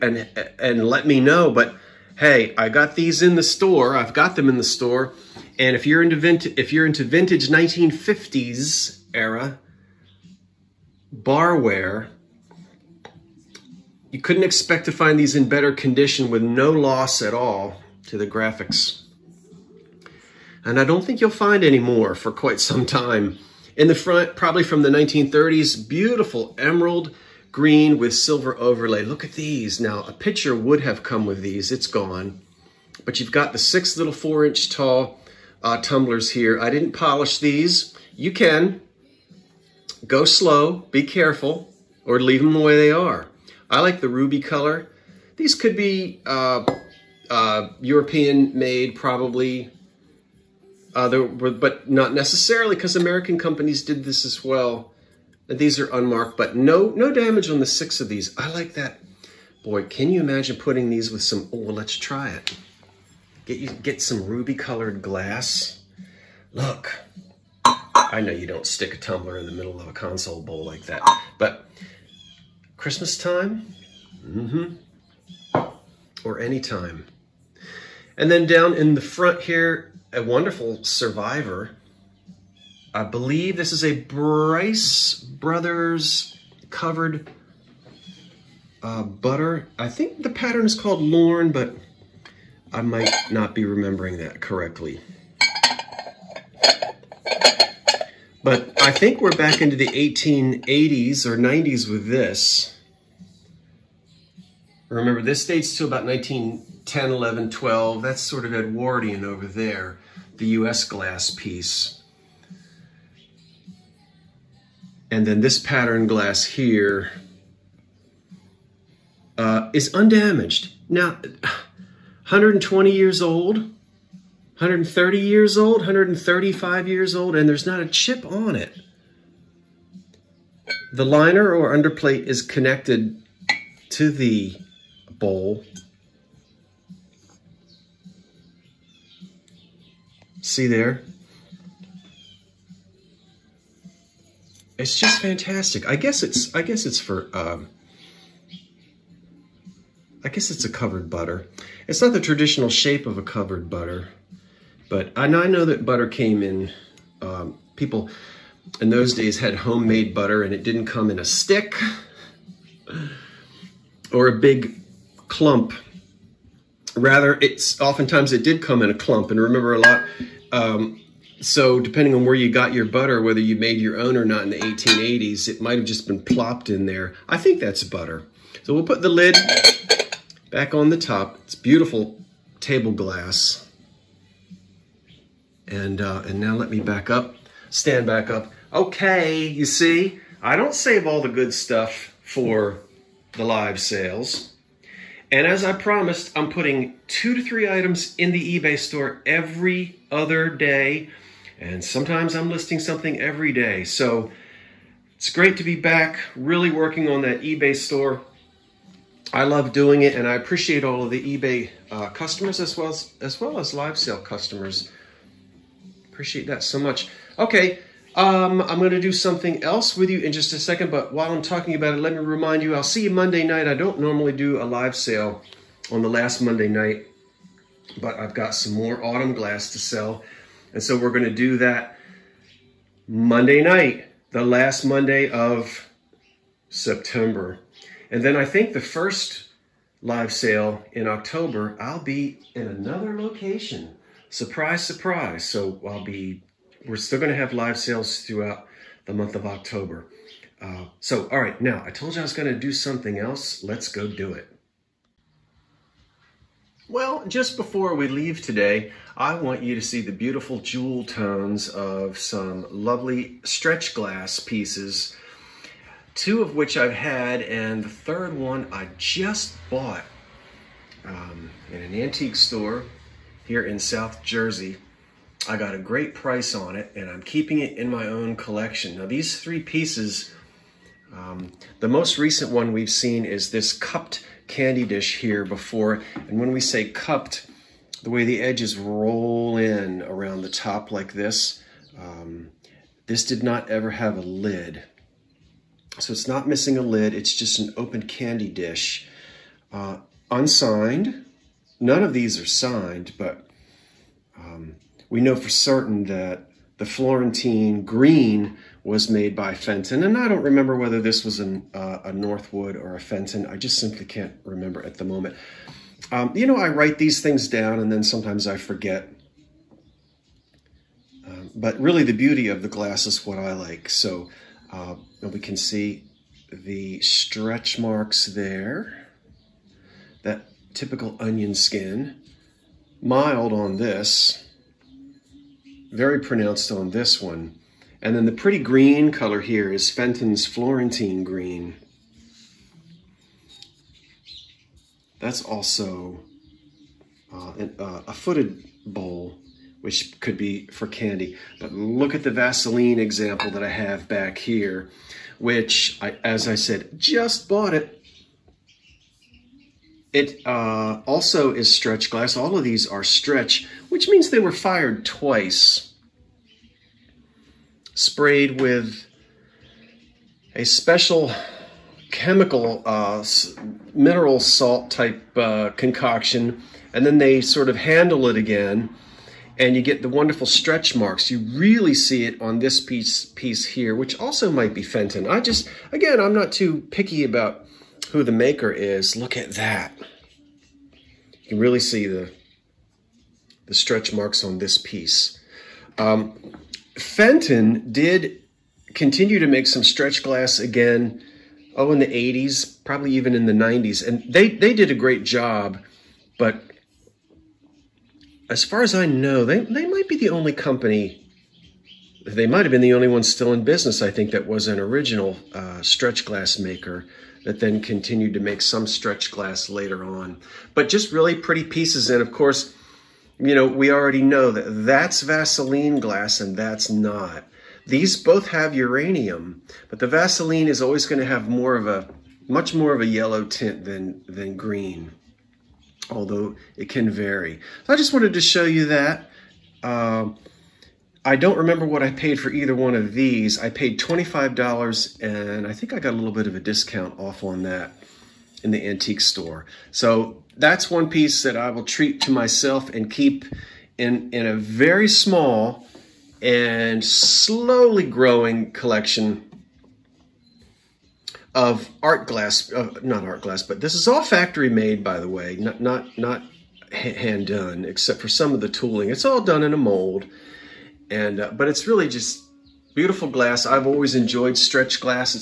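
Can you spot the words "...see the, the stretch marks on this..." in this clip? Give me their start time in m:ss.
6:31.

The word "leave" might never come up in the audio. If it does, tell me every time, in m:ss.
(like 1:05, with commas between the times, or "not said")
0:42, 4:18.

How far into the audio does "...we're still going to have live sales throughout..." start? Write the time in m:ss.
4:06.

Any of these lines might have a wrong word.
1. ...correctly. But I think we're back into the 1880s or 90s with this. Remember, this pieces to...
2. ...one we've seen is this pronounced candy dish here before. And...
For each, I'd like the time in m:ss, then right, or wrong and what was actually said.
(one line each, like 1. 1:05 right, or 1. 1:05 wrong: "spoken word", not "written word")
1. 1:34 wrong: "dates", not "pieces"
2. 4:42 wrong: "cupped", not "pronounced".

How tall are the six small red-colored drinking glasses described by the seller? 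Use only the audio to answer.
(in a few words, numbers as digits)
4 inches.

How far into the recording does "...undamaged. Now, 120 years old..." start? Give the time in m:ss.
1:59.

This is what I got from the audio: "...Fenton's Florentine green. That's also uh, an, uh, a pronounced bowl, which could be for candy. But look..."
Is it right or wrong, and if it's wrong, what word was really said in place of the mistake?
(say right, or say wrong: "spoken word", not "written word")
wrong: "footed", not "pronounced".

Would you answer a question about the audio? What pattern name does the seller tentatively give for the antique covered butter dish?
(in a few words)
Lorne.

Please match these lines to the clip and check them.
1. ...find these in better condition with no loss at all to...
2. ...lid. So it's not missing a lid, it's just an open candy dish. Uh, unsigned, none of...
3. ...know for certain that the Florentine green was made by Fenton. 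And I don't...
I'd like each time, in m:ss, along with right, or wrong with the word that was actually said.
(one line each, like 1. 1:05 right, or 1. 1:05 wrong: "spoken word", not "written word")
1. 0:14 right
2. 4:54 right
3. 5:05 right.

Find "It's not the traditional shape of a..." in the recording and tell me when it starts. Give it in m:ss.
2:31.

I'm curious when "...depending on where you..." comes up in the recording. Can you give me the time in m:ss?
2:51.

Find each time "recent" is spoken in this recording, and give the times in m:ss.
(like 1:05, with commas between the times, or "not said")
4:42.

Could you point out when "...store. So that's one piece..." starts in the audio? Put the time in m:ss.
7:29.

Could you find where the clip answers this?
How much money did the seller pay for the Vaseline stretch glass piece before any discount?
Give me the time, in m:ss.
7:23.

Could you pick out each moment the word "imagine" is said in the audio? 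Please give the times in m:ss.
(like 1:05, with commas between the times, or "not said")
1:00.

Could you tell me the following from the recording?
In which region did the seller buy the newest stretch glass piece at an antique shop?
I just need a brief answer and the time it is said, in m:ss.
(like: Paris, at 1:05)
South Jersey, at 4:33.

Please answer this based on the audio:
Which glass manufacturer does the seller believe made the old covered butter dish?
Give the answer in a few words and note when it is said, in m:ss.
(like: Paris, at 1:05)
Bryce Brothers, at 1:24.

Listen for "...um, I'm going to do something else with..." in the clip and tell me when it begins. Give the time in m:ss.
3:38.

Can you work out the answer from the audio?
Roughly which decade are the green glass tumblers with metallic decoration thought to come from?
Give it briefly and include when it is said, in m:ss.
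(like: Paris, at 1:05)
1930s, at 0:24.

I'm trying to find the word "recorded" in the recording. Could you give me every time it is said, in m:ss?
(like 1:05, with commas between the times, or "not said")
not said.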